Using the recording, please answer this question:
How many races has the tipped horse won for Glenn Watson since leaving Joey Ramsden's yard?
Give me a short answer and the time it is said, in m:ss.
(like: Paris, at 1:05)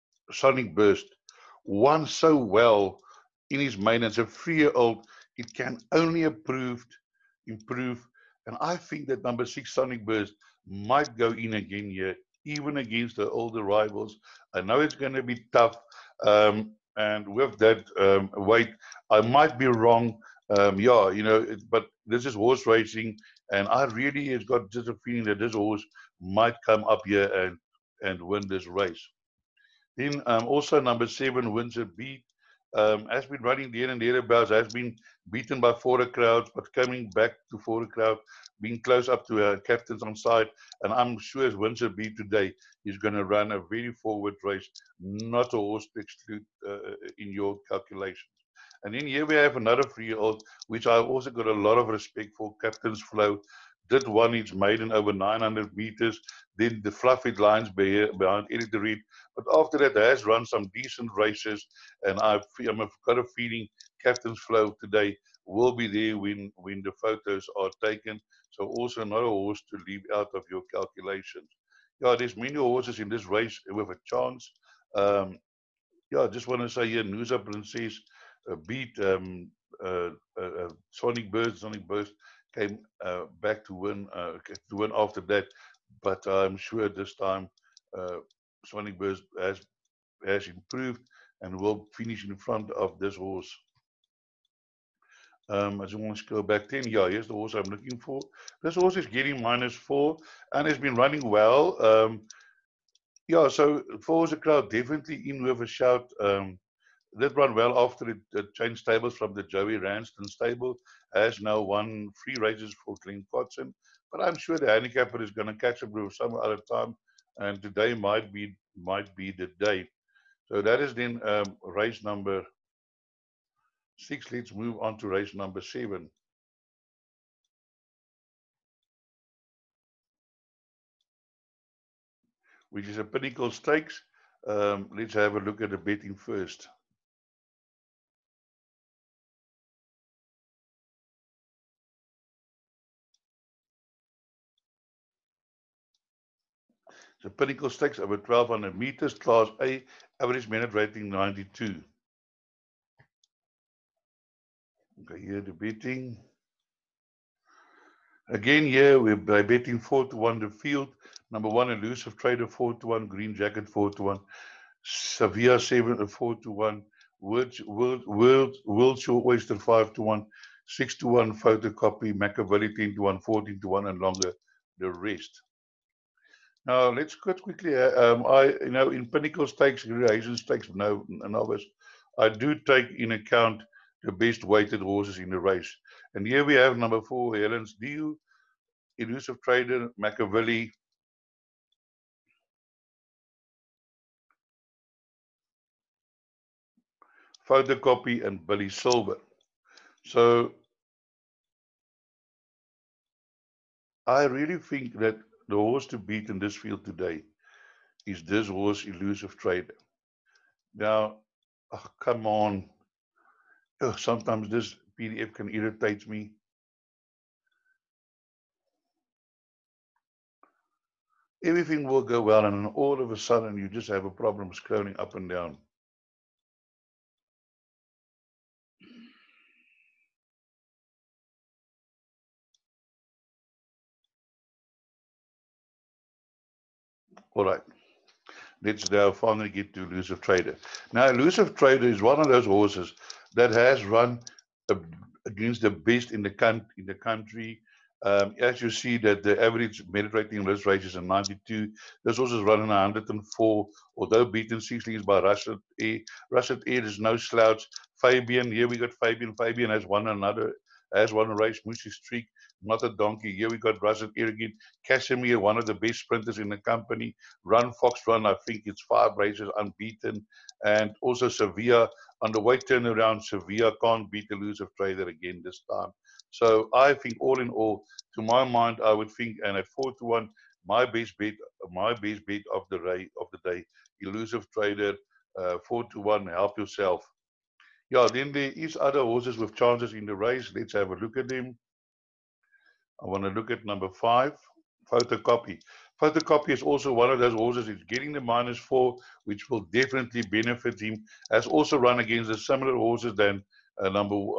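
3, at 1:52.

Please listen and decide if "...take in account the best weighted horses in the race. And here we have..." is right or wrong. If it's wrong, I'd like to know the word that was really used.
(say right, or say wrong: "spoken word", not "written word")
right.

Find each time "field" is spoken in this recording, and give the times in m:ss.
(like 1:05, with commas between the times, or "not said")
2:40, 3:26.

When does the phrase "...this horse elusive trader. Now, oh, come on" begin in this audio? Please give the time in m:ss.
3:28.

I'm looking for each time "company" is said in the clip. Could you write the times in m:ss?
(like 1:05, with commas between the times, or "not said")
4:26.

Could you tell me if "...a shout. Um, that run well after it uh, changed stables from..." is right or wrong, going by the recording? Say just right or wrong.
right.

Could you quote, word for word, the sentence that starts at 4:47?
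Yeah, then there is other horses with chances in the race.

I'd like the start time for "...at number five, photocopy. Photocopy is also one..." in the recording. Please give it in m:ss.
4:53.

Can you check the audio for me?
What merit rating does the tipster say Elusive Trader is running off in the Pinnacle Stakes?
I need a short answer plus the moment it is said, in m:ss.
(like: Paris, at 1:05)
104, at 4:12.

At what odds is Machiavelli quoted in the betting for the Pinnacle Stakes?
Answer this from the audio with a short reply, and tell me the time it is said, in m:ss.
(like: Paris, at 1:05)
10 to 1, at 2:52.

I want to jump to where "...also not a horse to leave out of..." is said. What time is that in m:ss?
1:08.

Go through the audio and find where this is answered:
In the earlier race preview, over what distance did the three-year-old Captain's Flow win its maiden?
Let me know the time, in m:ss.
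0:55.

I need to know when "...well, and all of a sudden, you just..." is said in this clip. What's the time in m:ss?
3:42.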